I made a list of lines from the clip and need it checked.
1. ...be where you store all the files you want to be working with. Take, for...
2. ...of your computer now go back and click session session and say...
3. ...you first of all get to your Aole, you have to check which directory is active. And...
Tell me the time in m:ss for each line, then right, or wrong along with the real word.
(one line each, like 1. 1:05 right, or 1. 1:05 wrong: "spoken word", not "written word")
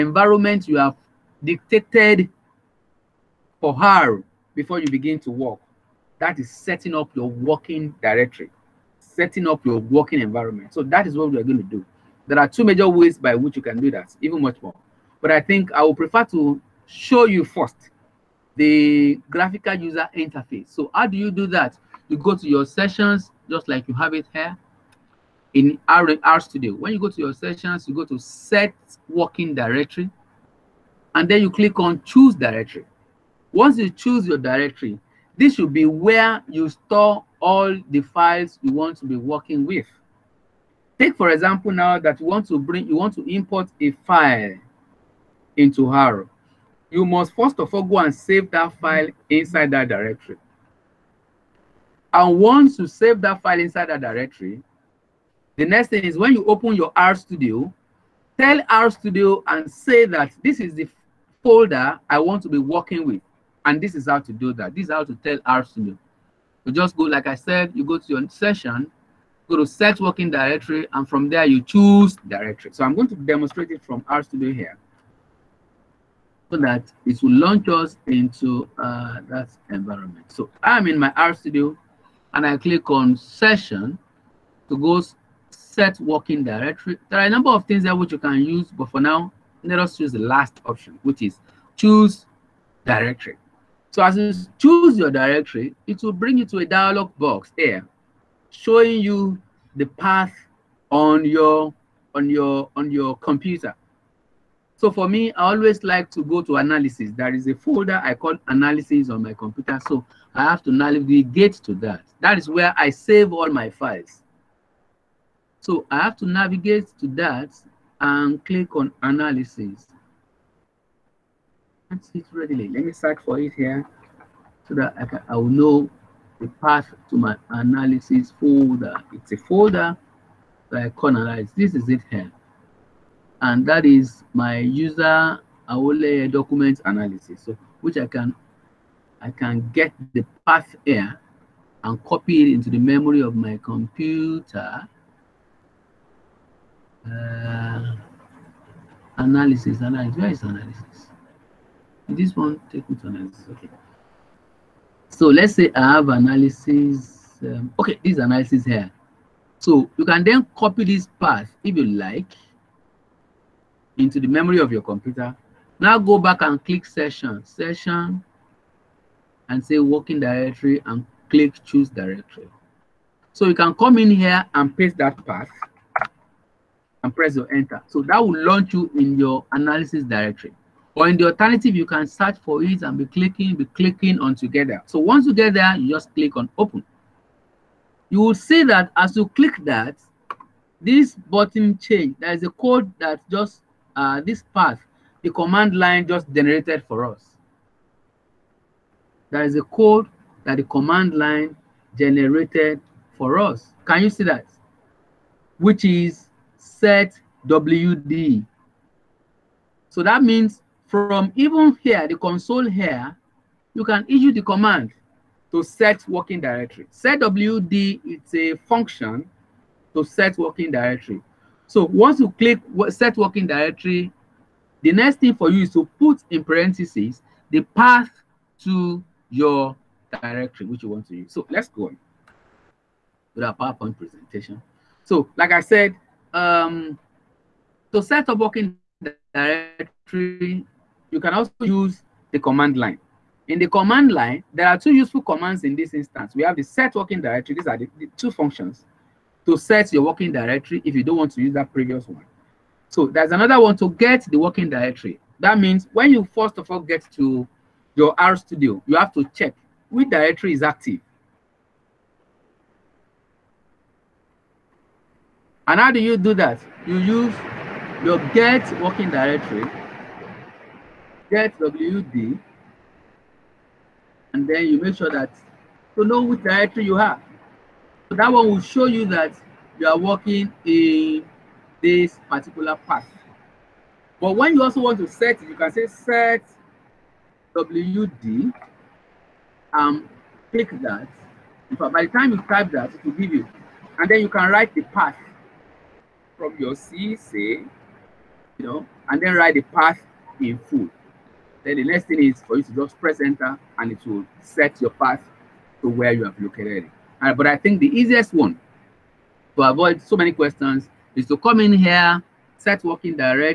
1. 0:35 right
2. 2:44 right
3. 4:16 wrong: "RStudio", not "Aole".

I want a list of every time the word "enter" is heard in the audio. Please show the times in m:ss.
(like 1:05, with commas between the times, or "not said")
2:57, 5:03.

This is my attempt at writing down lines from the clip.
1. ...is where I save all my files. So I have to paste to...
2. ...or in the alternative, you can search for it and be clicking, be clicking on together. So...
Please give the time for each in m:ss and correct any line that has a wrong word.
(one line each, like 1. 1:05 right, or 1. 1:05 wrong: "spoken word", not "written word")
1. 1:52 wrong: "navigate", not "paste"
2. 3:00 right.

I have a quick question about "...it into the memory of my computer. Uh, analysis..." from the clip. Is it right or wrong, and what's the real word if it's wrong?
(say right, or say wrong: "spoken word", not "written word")
right.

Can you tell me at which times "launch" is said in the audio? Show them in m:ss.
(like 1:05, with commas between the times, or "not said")
1:17, 2:58.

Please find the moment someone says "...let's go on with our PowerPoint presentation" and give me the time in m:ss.
3:51.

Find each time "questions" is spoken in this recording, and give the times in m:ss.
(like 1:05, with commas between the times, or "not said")
5:10.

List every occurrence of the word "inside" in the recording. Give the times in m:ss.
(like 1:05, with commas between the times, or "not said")
0:49, 0:53.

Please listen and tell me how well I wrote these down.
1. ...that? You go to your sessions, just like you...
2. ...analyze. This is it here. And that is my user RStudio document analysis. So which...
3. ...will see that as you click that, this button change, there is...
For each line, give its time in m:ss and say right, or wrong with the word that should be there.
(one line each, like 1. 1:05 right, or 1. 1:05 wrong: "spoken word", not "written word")
1. 0:21 right
2. 2:11 wrong: "Aole", not "RStudio"
3. 3:08 right.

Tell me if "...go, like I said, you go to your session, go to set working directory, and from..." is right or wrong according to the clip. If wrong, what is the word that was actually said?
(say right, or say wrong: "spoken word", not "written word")
right.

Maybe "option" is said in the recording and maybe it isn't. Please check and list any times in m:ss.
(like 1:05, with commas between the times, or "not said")
1:30.